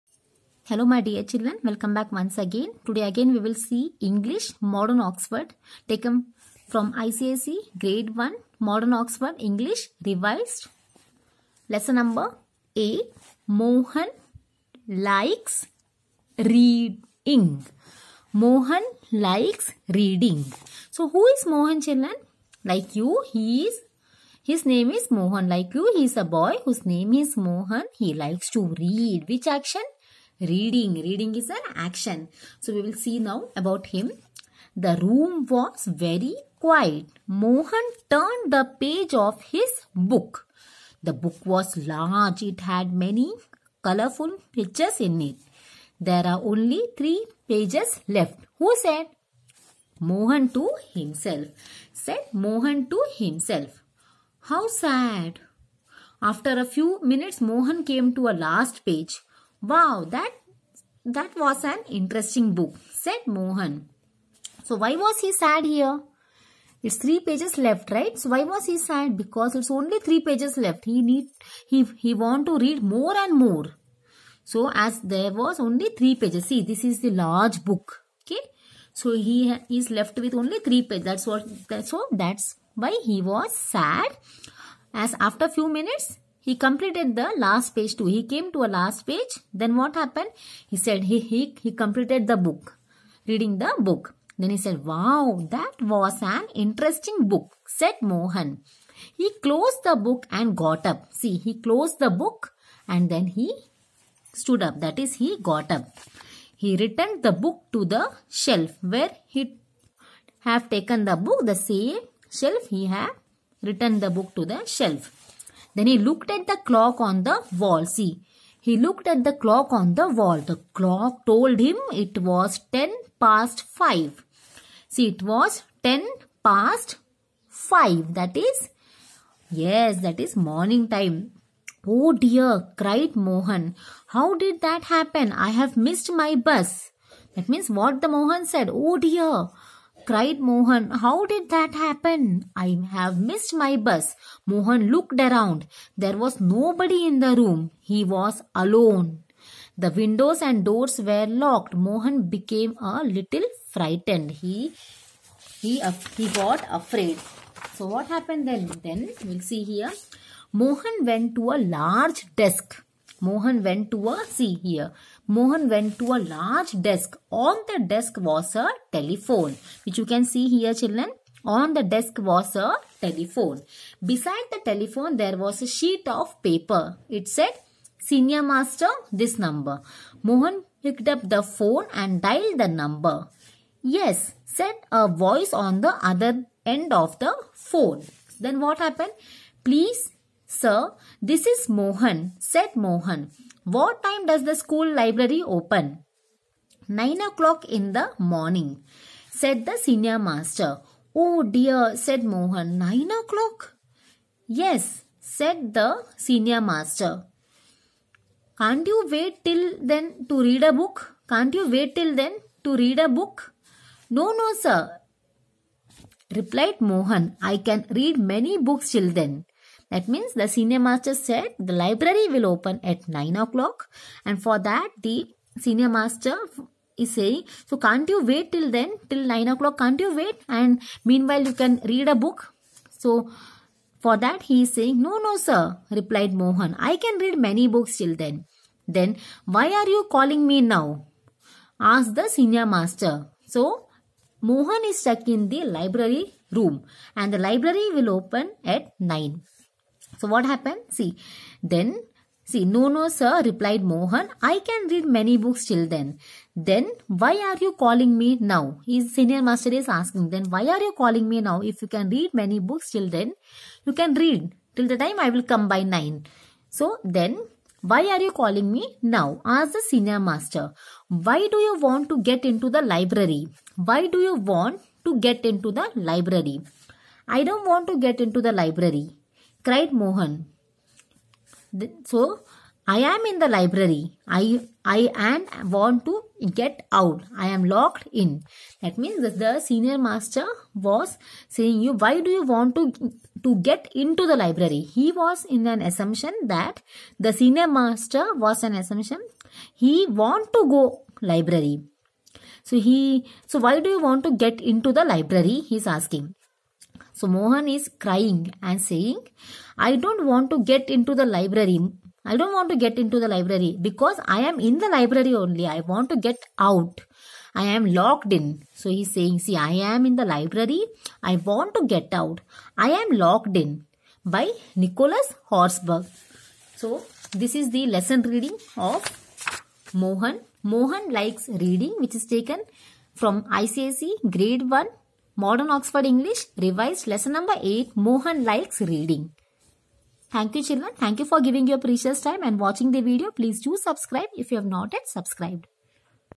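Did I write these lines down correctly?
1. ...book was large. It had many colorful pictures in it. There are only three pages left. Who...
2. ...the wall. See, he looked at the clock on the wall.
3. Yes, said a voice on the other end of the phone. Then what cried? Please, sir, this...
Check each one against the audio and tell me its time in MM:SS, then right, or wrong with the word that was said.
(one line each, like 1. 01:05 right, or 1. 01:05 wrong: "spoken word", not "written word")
1. 00:41 right
2. 01:57 right
3. 03:03 wrong: "happened", not "cried".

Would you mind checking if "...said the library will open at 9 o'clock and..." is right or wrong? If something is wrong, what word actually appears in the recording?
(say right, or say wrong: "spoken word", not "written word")
right.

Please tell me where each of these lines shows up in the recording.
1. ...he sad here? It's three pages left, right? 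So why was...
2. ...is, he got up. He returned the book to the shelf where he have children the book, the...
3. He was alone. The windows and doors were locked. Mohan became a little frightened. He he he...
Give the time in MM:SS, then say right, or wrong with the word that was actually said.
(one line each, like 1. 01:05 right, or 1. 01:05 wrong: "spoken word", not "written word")
1. 01:05 right
2. 01:44 wrong: "taken", not "children"
3. 02:27 right.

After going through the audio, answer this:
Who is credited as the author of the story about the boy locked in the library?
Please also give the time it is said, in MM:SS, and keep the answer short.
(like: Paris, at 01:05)
Nicholas Horsburgh, at 05:24.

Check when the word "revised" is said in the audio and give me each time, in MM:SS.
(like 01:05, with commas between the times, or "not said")
00:10, 05:36.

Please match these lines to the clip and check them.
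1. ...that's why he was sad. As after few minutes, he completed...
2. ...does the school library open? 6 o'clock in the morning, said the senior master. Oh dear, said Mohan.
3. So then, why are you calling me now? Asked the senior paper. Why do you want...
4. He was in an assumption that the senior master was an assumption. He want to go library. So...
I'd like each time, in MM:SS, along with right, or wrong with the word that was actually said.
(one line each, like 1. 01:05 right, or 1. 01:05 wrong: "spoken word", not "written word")
1. 01:22 right
2. 03:14 wrong: "9", not "6"
3. 04:26 wrong: "master", not "paper"
4. 04:54 right.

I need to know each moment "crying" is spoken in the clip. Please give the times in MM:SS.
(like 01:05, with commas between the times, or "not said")
05:08.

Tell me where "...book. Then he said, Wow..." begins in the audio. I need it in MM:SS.
01:33.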